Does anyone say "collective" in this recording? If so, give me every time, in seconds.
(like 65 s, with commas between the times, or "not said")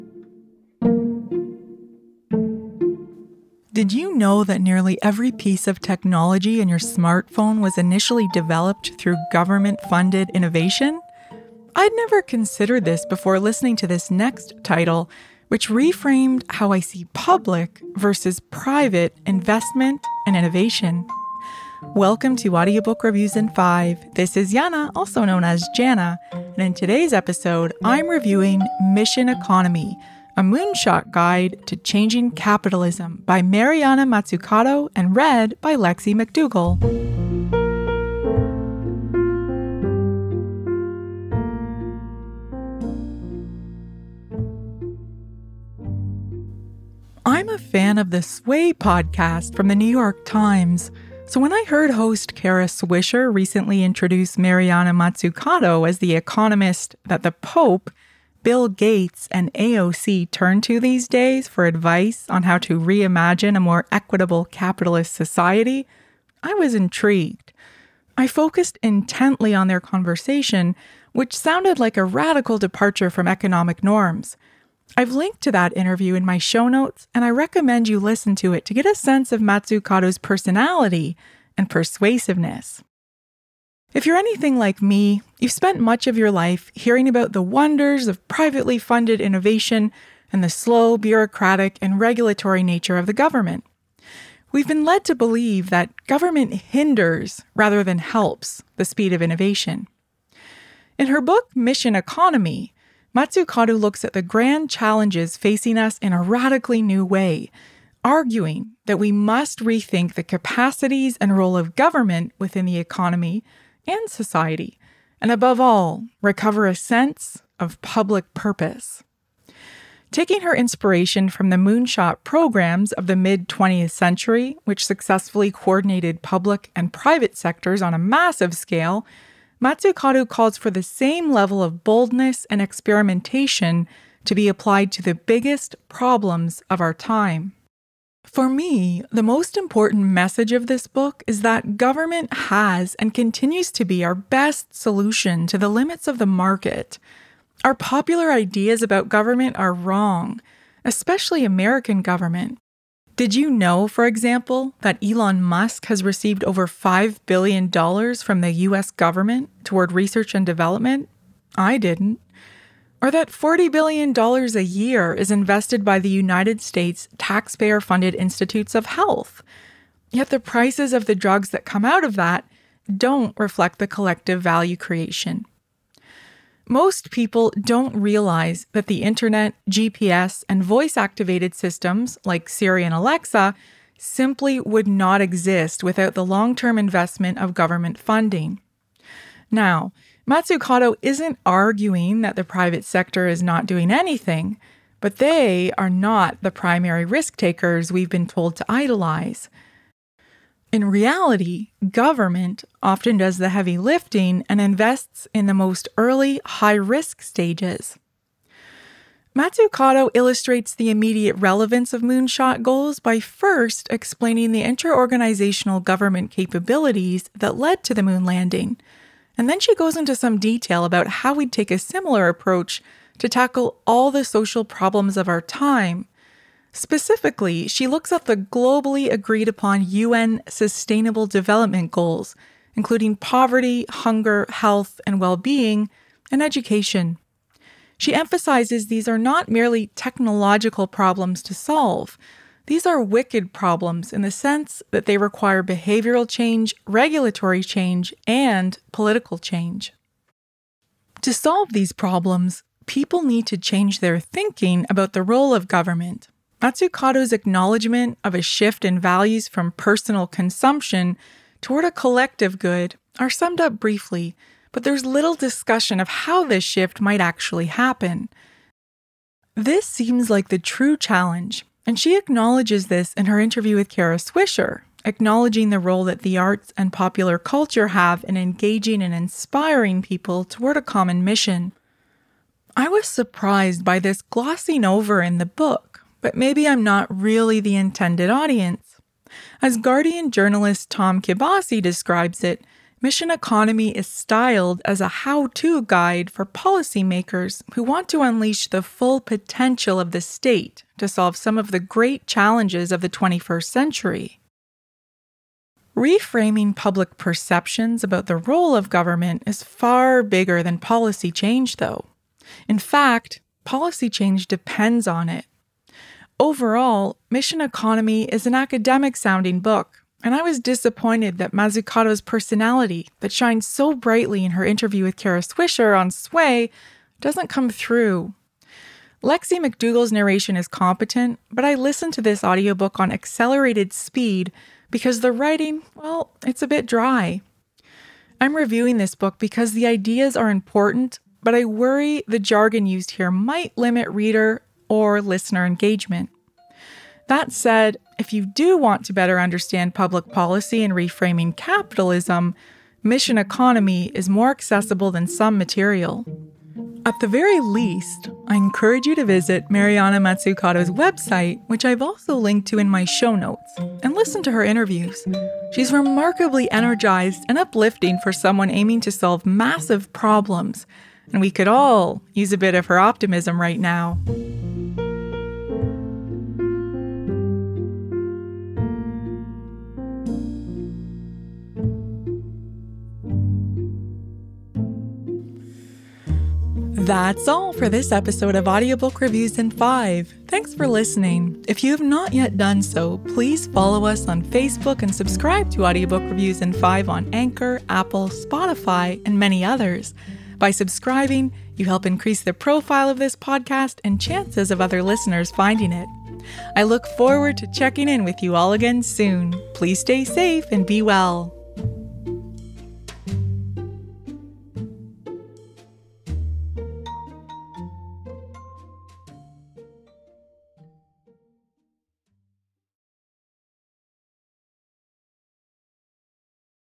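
173 s, 261 s.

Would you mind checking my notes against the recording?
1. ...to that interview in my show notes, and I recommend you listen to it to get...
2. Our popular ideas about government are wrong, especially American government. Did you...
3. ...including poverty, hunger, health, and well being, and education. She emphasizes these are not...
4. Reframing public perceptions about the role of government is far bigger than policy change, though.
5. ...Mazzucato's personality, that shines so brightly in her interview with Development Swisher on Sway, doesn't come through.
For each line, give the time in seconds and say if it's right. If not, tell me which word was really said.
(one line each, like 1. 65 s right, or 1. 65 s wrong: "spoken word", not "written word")
1. 75 s right
2. 147 s right
3. 232 s right
4. 305 s right
5. 321 s wrong: "Kara", not "Development".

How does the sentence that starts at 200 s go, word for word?
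In reality, government often does the heavy lifting and invests in the most early high risk stages.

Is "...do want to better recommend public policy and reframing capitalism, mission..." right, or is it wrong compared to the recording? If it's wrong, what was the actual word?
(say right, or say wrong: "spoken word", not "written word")
wrong: "understand", not "recommend".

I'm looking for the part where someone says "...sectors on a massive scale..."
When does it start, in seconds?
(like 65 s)
127 s.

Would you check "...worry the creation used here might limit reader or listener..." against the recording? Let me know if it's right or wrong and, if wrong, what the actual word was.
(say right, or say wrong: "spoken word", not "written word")
wrong: "jargon", not "creation".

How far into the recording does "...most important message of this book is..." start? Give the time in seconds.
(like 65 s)
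139 s.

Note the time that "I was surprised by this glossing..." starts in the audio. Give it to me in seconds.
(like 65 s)
282 s.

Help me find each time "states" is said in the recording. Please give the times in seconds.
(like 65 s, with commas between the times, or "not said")
166 s, 300 s.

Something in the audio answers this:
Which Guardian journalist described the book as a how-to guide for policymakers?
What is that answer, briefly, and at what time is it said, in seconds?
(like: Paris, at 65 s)
Tom Kibasi, at 290 s.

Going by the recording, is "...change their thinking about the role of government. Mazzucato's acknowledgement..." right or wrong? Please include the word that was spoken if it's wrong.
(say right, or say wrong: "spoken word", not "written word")
right.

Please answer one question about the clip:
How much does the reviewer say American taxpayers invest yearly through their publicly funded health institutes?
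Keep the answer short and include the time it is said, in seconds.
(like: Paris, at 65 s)
$40 billion, at 163 s.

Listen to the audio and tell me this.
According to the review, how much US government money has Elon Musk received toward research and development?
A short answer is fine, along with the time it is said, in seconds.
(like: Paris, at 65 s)
over $5 billion, at 156 s.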